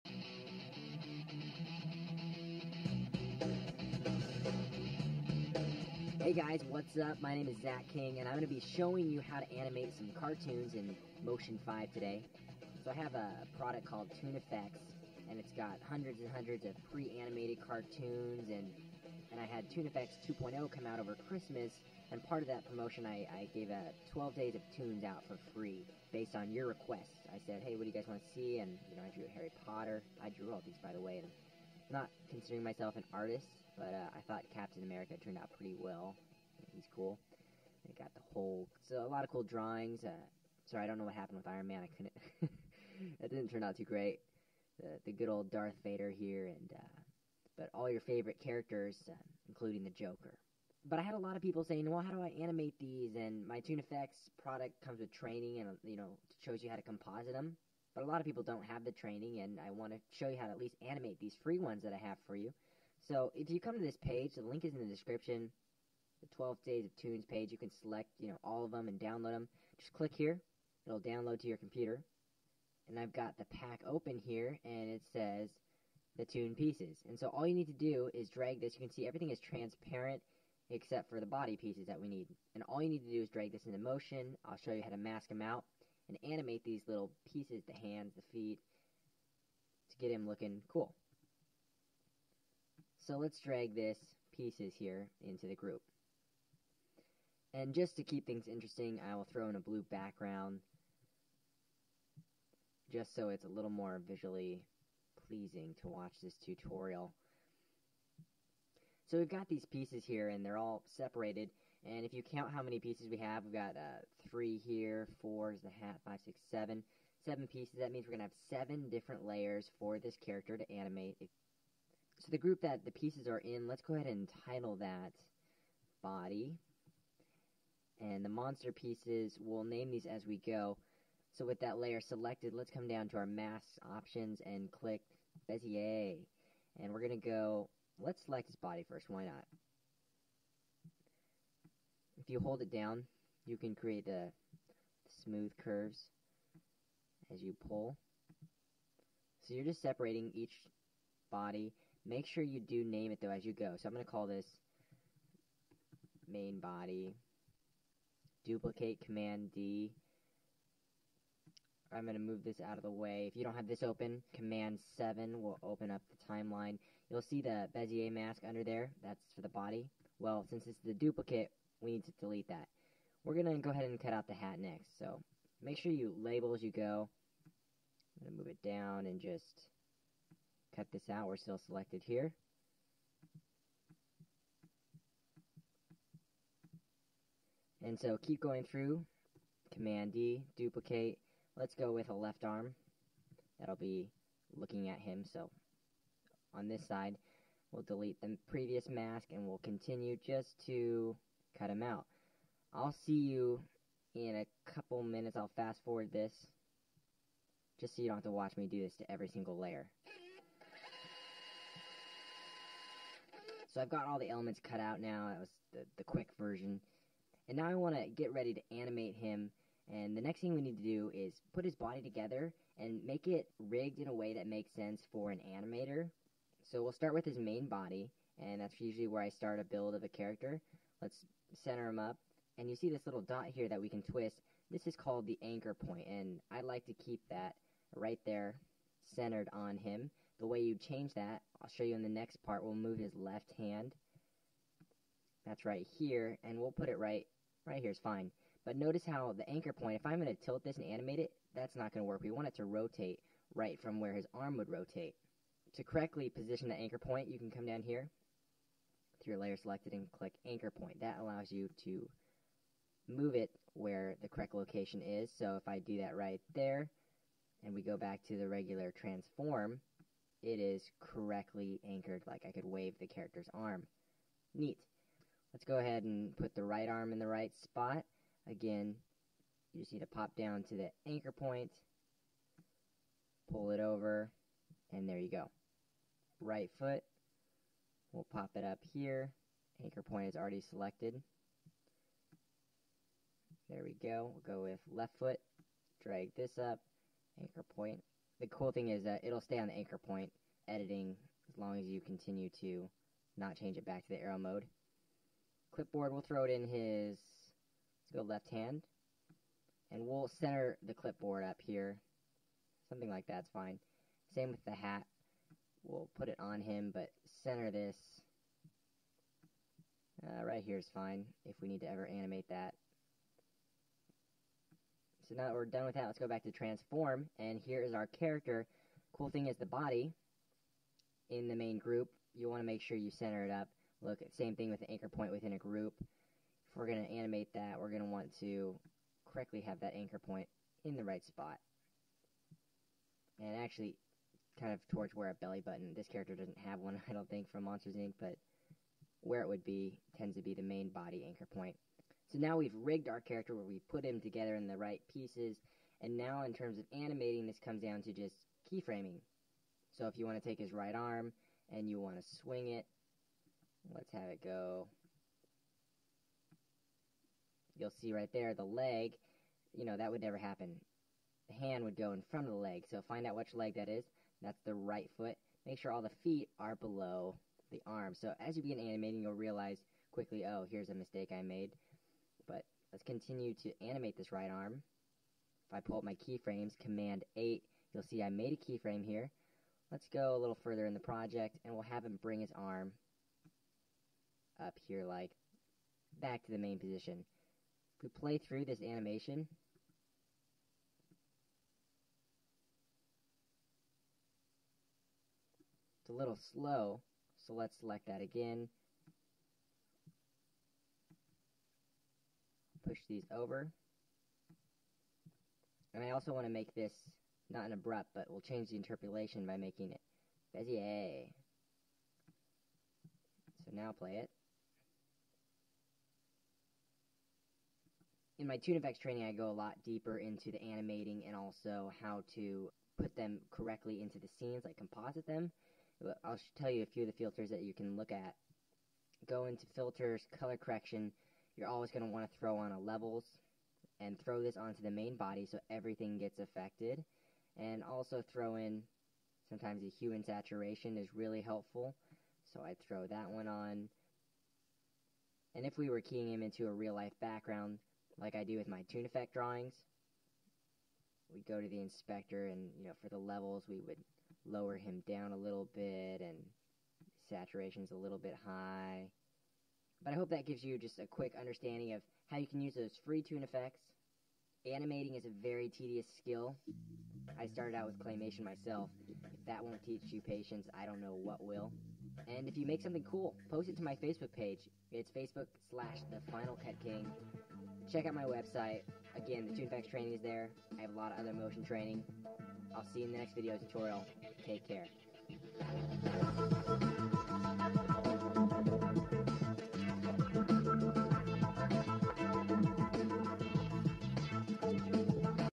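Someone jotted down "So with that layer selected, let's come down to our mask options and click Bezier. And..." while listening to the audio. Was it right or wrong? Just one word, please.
right.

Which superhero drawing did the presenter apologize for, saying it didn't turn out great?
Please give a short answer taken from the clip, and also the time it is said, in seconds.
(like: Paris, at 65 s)
Iron Man, at 41 s.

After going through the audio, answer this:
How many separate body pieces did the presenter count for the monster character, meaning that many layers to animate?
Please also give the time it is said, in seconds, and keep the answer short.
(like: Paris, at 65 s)
7, at 117 s.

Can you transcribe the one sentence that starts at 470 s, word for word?
But I hope that gives you just a quick understanding of how you can use those free Toon Effects.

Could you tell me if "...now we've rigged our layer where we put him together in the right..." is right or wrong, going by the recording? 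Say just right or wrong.
wrong.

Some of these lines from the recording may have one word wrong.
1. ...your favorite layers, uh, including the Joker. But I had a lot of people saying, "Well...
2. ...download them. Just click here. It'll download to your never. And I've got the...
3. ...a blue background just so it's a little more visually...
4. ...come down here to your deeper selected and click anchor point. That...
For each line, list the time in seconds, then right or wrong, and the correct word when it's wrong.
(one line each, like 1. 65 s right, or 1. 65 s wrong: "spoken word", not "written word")
1. 47 s wrong: "characters", not "layers"
2. 68 s wrong: "computer", not "never"
3. 99 s right
4. 257 s wrong: "layer", not "deeper".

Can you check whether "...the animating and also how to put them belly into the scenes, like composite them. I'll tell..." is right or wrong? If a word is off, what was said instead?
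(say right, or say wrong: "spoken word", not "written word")
wrong: "correctly", not "belly".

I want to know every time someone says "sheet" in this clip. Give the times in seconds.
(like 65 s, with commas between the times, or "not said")
not said.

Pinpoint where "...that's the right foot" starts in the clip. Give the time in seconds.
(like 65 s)
374 s.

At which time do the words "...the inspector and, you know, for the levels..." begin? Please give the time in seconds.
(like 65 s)
461 s.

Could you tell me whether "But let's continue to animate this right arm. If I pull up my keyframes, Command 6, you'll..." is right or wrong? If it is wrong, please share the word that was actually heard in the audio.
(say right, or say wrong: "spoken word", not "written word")
wrong: "8", not "6".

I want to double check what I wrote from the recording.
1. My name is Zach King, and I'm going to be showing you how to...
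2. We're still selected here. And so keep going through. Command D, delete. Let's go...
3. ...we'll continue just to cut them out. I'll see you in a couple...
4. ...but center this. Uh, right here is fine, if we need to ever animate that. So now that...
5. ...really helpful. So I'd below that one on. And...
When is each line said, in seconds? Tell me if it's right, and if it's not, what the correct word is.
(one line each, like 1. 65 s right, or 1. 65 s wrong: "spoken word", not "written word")
1. 7 s right
2. 181 s wrong: "duplicate", not "delete"
3. 199 s right
4. 316 s right
5. 451 s wrong: "throw", not "below".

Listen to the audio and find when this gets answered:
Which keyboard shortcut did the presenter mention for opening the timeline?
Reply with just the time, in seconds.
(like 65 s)
164 s.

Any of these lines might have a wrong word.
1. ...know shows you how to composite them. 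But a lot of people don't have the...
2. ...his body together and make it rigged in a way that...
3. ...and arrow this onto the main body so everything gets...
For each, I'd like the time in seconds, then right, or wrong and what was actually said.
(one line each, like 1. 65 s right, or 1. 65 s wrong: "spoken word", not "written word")
1. 55 s right
2. 221 s right
3. 443 s wrong: "throw", not "arrow".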